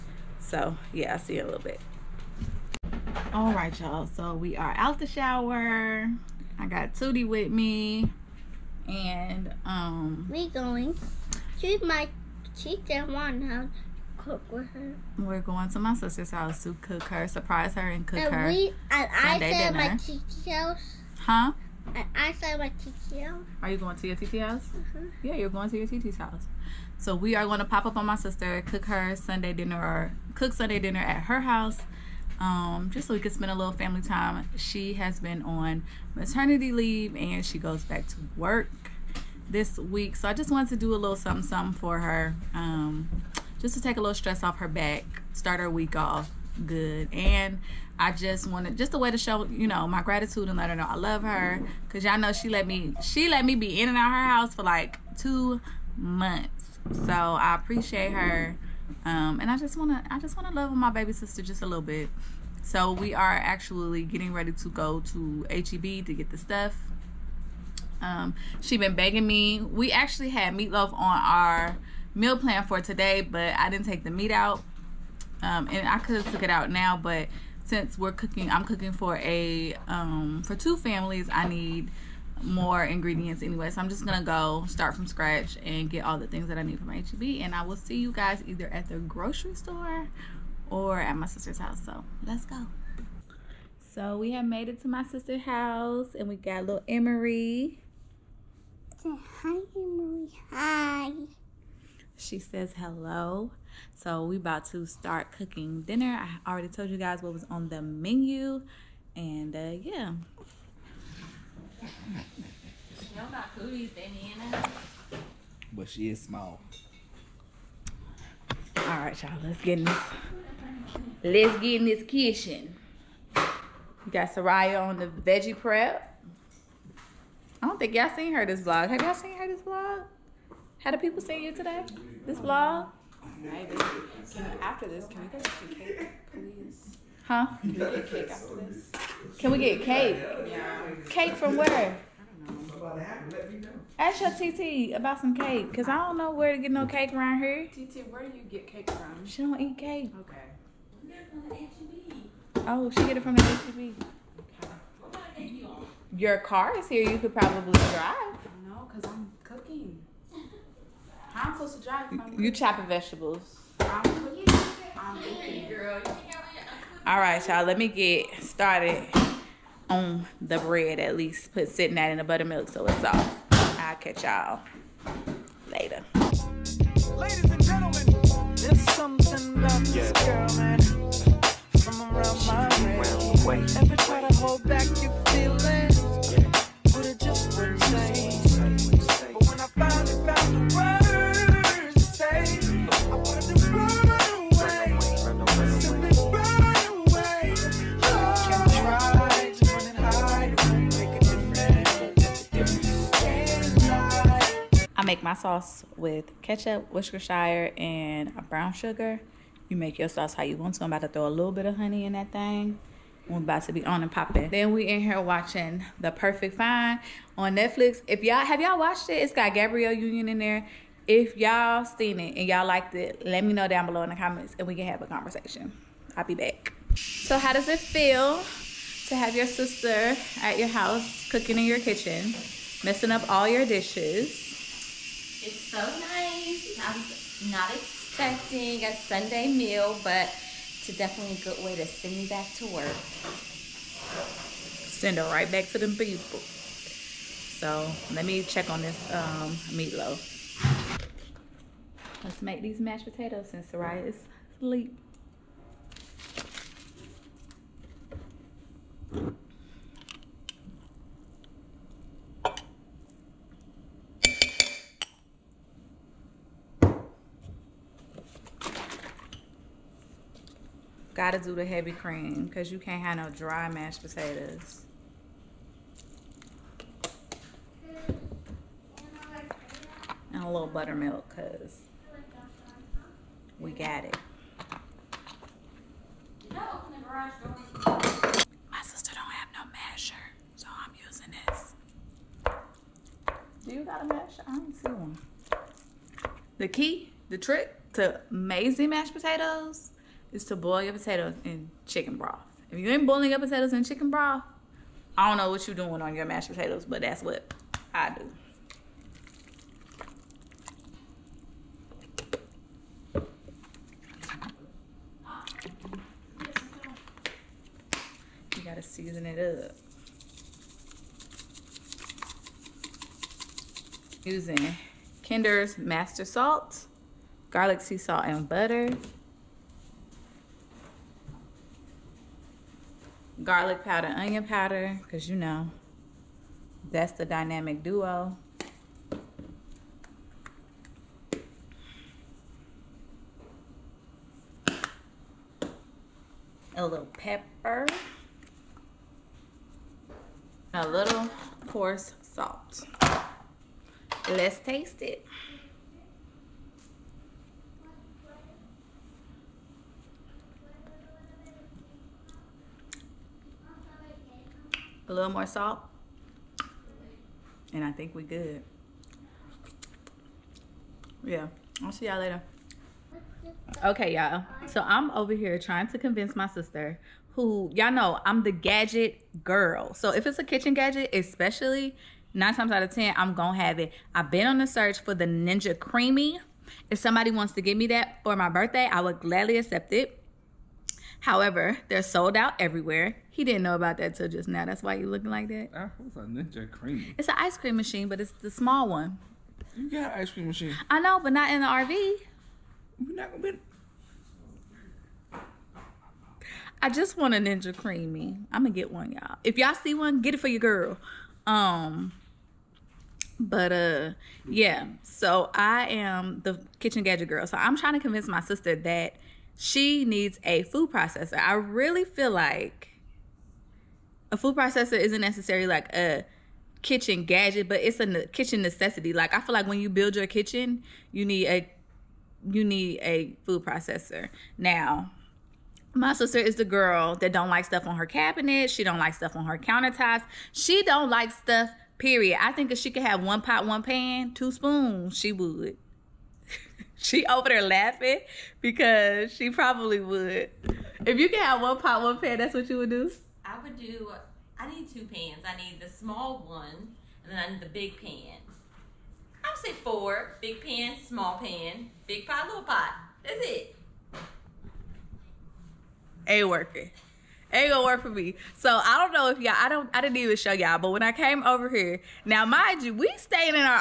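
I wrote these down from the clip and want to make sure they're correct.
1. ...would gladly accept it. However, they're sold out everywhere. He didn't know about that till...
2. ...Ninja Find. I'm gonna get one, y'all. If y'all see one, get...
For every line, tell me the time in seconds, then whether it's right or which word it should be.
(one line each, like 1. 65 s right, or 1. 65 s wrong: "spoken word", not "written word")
1. 389 s right
2. 407 s wrong: "CREAMi", not "Find".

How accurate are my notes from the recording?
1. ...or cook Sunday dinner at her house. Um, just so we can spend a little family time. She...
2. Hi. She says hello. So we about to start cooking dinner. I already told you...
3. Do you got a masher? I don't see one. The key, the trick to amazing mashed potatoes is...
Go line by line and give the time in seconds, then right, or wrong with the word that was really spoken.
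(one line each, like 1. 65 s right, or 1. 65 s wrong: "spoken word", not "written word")
1. 29 s right
2. 100 s right
3. 293 s right.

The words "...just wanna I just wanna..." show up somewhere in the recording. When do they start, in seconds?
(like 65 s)
59 s.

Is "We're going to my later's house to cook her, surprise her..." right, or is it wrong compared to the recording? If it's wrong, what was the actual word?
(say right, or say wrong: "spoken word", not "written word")
wrong: "sister", not "later".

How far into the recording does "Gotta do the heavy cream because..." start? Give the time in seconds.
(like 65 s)
271 s.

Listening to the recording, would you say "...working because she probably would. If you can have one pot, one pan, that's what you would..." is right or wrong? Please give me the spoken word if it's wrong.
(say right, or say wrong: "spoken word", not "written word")
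wrong: "laughing", not "working".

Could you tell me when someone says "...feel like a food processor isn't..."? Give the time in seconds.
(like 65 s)
422 s.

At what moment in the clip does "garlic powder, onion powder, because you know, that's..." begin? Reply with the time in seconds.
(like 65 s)
333 s.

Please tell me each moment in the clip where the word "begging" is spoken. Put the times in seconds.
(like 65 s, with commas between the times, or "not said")
68 s.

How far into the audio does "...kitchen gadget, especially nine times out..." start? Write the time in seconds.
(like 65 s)
380 s.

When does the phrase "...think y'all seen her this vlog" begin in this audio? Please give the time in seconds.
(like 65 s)
127 s.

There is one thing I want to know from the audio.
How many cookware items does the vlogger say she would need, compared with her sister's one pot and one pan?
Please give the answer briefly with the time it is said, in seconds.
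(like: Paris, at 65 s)
4, at 459 s.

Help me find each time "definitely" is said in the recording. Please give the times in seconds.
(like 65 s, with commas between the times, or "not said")
240 s.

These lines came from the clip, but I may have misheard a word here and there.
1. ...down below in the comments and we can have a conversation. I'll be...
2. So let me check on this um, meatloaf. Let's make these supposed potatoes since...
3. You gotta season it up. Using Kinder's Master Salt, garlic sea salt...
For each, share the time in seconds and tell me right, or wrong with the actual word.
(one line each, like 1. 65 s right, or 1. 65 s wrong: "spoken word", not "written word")
1. 223 s right
2. 247 s wrong: "mashed", not "supposed"
3. 318 s right.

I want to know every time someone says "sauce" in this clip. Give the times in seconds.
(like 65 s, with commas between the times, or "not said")
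205 s, 210 s.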